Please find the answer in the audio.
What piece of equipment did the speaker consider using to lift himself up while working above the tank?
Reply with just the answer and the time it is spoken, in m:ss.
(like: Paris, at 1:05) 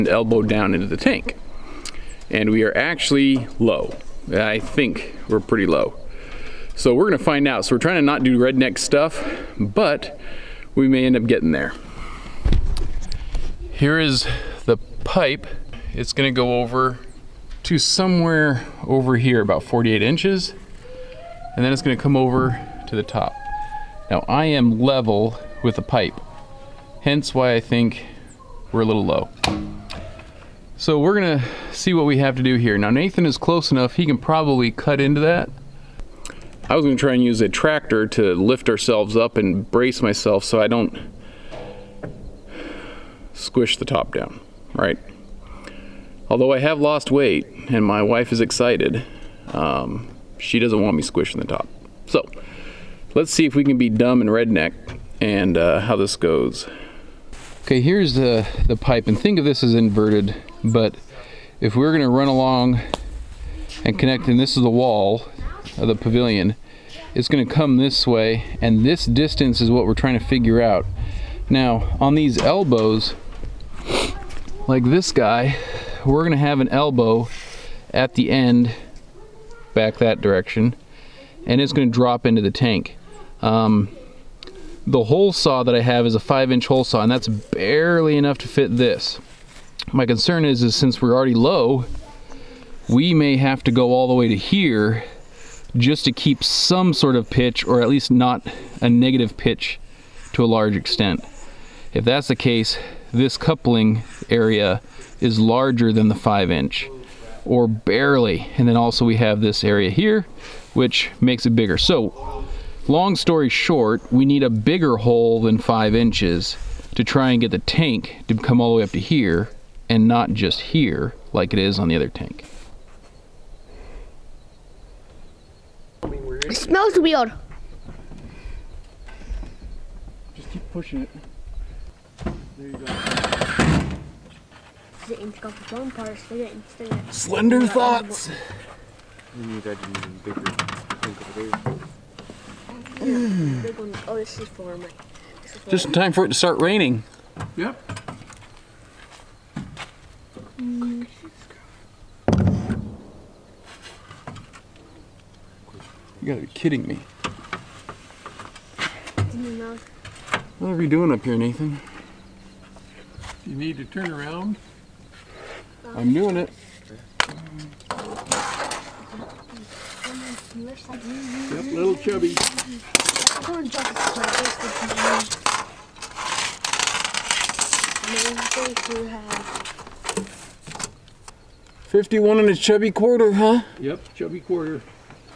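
tractor, at 0:37.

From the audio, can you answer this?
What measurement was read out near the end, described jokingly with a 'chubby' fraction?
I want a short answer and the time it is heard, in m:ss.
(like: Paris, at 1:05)
51 and a quarter, at 3:01.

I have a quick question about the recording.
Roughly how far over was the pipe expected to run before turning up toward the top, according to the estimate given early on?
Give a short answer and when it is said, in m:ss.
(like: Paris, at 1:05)
48 inches, at 0:19.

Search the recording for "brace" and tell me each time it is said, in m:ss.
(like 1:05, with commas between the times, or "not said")
0:39.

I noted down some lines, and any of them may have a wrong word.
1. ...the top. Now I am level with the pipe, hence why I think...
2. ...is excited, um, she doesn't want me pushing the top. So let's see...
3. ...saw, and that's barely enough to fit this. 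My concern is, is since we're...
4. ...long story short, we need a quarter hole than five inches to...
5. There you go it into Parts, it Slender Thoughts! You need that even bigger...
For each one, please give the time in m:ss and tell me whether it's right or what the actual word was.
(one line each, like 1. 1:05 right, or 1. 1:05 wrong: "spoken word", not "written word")
1. 0:22 right
2. 0:48 wrong: "squishing", not "pushing"
3. 1:26 right
4. 1:52 wrong: "bigger", not "quarter"
5. 2:12 right.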